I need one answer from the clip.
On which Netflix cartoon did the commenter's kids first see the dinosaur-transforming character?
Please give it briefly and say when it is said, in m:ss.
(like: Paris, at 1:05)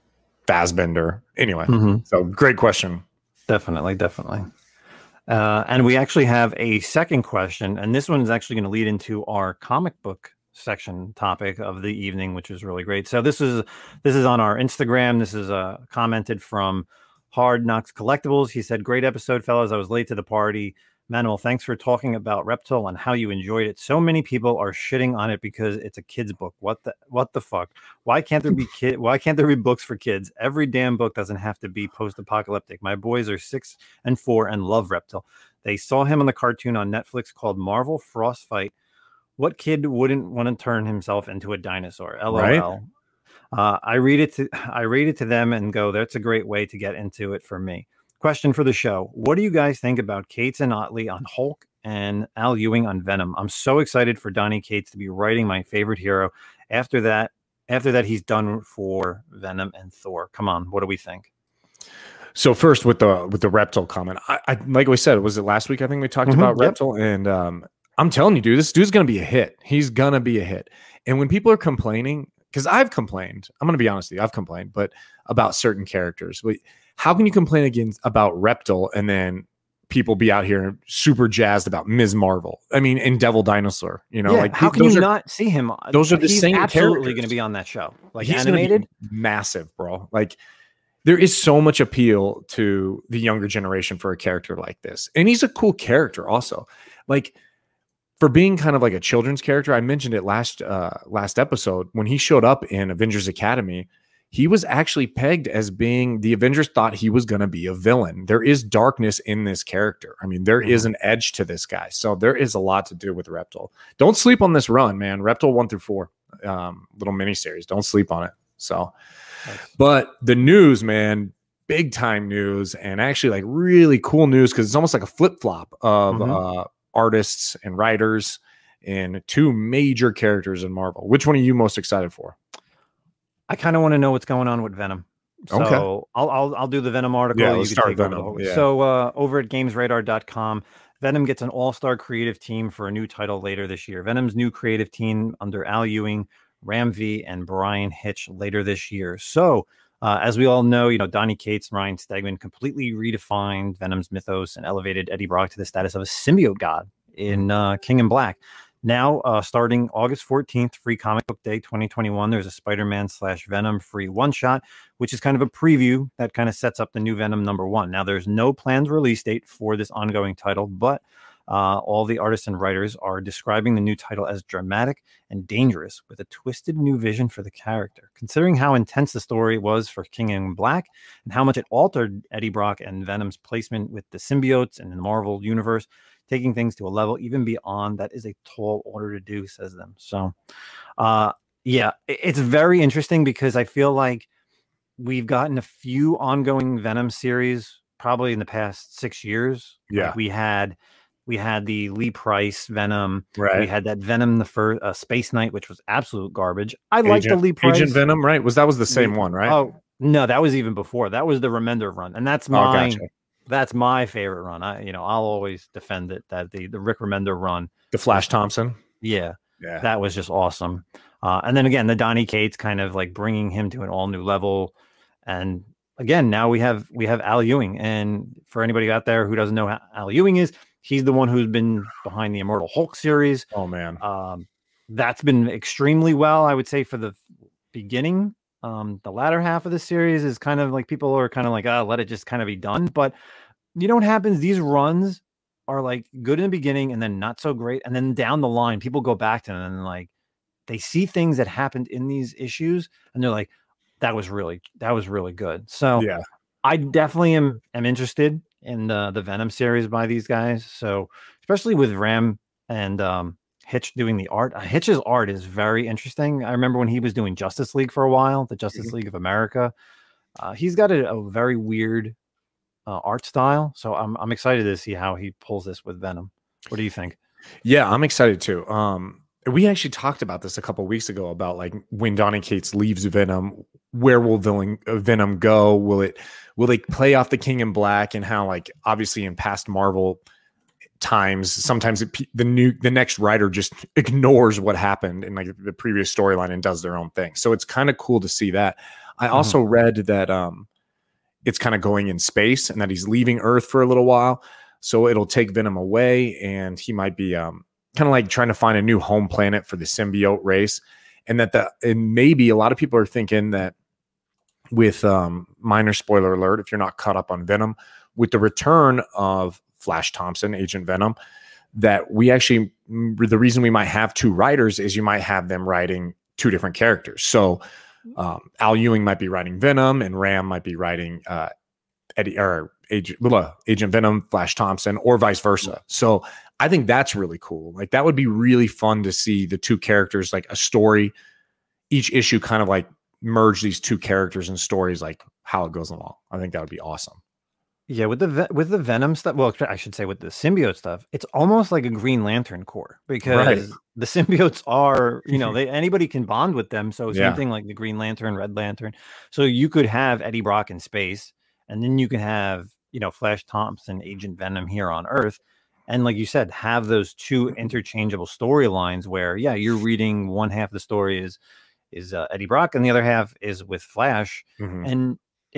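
Marvel Frostfight, at 0:37.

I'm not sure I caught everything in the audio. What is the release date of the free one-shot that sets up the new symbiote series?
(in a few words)
August 14th.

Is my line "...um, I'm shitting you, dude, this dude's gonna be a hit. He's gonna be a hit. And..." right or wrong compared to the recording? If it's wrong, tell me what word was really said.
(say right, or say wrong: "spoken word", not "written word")
wrong: "telling", not "shitting".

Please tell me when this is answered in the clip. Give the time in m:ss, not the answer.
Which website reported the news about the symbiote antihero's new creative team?
2:19.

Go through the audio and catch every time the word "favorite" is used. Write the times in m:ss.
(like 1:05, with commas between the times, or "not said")
0:55, 3:34.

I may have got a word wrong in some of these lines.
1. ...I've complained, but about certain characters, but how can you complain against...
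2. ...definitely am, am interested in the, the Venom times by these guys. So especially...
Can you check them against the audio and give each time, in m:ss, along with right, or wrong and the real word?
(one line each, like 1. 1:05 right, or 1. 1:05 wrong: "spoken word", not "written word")
1. 1:14 right
2. 4:16 wrong: "series", not "times".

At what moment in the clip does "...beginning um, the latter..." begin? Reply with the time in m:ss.
3:57.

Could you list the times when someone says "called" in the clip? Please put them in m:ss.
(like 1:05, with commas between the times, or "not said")
0:37.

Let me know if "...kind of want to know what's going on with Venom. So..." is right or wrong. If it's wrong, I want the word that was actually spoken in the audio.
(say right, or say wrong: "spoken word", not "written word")
right.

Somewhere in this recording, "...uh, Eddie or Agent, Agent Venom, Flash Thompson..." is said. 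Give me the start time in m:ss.
5:31.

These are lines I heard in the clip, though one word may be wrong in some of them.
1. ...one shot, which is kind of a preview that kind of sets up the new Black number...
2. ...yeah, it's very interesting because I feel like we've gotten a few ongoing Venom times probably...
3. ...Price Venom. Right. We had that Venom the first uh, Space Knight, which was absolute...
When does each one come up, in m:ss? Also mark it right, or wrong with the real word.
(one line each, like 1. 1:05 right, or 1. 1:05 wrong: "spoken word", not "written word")
1. 2:44 wrong: "Venom", not "Black"
2. 3:11 wrong: "series", not "times"
3. 3:22 right.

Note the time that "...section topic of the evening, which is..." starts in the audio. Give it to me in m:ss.
0:10.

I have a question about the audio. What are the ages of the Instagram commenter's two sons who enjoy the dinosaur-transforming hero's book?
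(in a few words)
6 and 4.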